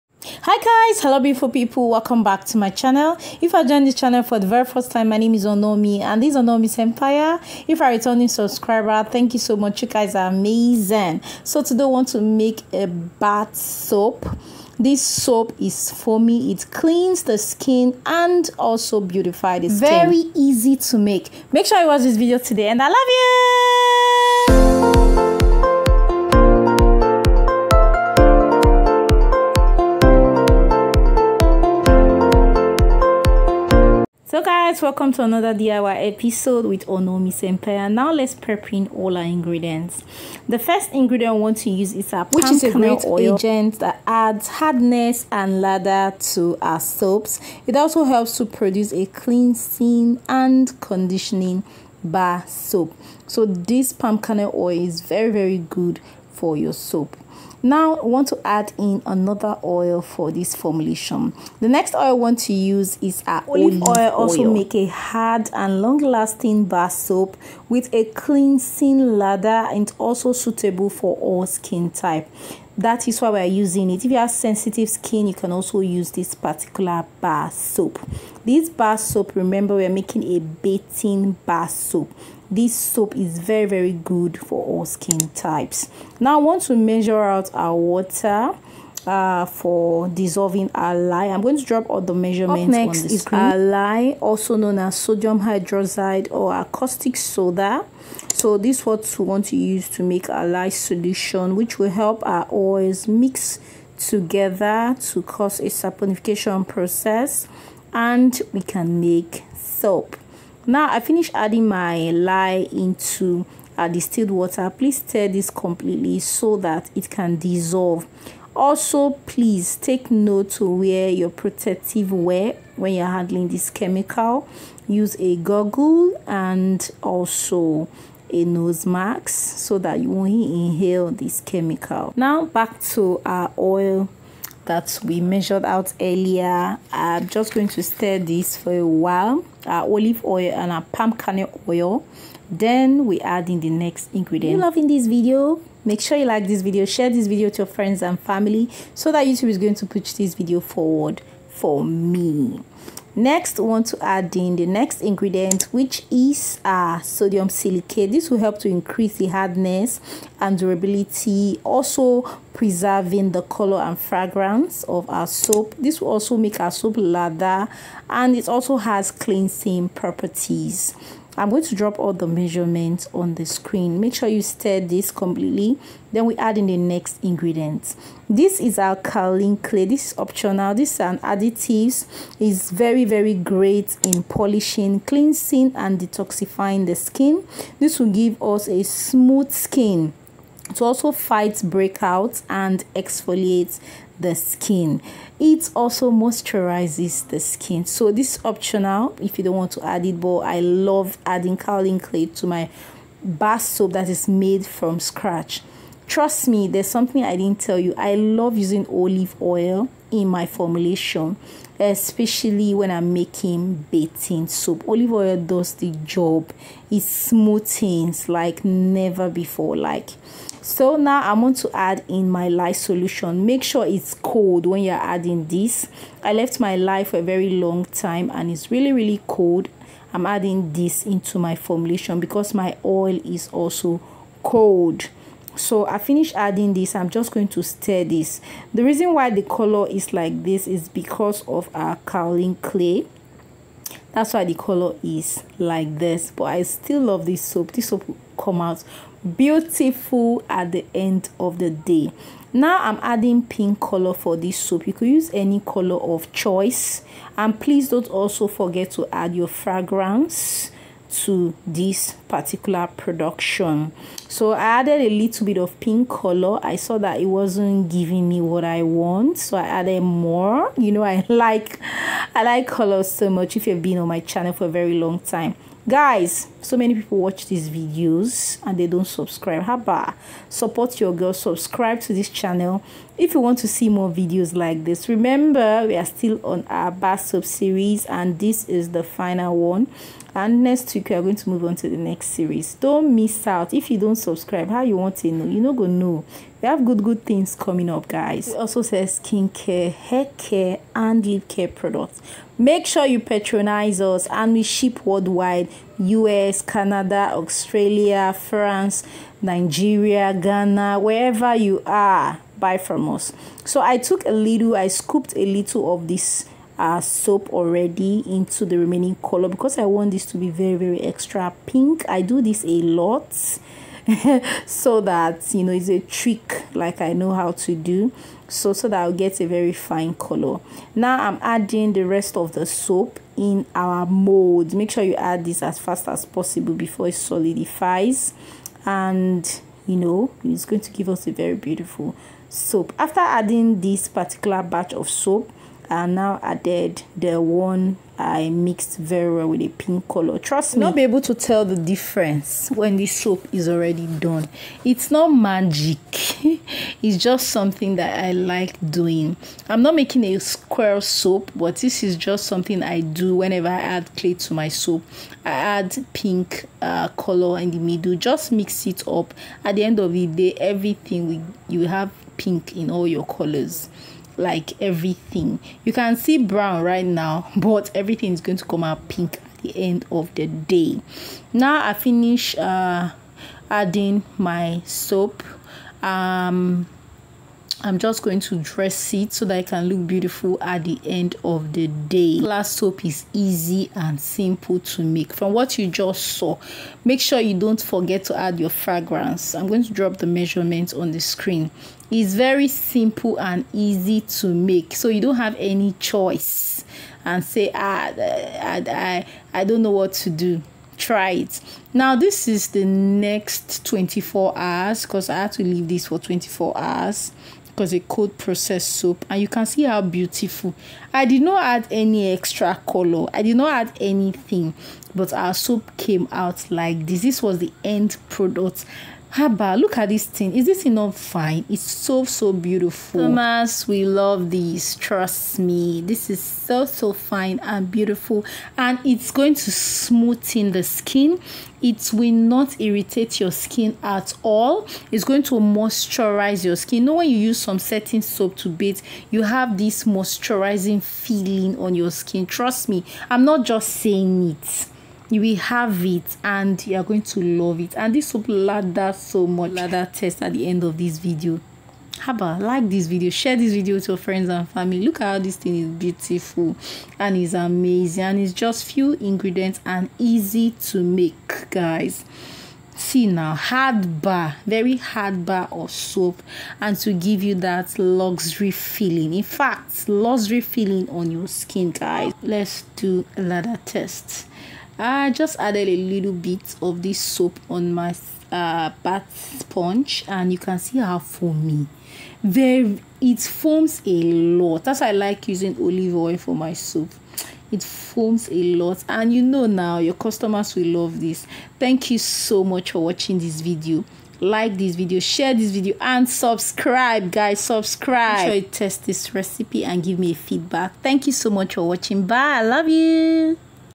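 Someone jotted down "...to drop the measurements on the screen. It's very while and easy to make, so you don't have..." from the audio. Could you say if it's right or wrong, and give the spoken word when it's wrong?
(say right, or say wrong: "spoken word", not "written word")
wrong: "simple", not "while".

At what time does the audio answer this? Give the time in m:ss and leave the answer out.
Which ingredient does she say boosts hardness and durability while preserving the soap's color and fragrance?
2:36.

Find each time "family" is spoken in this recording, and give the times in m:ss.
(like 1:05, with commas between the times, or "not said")
2:28, 7:44.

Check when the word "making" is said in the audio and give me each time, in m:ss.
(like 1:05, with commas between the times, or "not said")
1:19, 3:33, 5:59.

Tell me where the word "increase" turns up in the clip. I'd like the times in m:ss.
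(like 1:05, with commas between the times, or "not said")
2:38.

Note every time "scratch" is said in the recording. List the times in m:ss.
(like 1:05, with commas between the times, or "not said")
3:24.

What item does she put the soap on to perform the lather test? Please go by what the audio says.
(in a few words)
Bath sponge.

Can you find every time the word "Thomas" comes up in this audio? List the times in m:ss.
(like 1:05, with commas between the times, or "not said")
7:13.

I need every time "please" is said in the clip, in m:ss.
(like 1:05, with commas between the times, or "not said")
1:54, 1:59, 4:17.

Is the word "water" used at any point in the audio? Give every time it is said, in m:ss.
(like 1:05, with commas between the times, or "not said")
1:27, 1:54.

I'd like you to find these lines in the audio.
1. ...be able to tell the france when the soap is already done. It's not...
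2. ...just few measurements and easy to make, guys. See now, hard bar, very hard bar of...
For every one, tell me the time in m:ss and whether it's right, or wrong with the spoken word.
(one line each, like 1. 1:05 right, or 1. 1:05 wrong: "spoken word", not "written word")
1. 5:50 wrong: "difference", not "france"
2. 7:48 wrong: "ingredients", not "measurements".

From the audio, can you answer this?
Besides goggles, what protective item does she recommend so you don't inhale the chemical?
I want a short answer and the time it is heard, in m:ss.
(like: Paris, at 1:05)
Nose mask, at 2:08.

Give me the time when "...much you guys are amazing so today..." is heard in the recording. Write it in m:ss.
0:09.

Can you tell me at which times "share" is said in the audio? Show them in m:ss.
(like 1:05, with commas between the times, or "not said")
2:26, 7:43, 8:25.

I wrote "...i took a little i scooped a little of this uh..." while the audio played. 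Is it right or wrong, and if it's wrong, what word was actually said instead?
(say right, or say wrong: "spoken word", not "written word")
right.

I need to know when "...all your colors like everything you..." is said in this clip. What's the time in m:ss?
6:12.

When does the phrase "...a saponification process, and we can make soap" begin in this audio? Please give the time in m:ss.
1:45.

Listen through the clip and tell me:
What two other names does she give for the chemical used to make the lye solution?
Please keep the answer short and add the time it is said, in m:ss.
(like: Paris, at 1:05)
Sodium hydroxide or caustic soda, at 1:34.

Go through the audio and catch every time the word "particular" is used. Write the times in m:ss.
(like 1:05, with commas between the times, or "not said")
1:16, 4:22, 5:44.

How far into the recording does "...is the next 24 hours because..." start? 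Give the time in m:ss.
6:52.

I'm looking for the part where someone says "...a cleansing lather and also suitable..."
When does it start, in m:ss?
1:07.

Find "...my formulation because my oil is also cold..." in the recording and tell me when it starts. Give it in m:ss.
3:51.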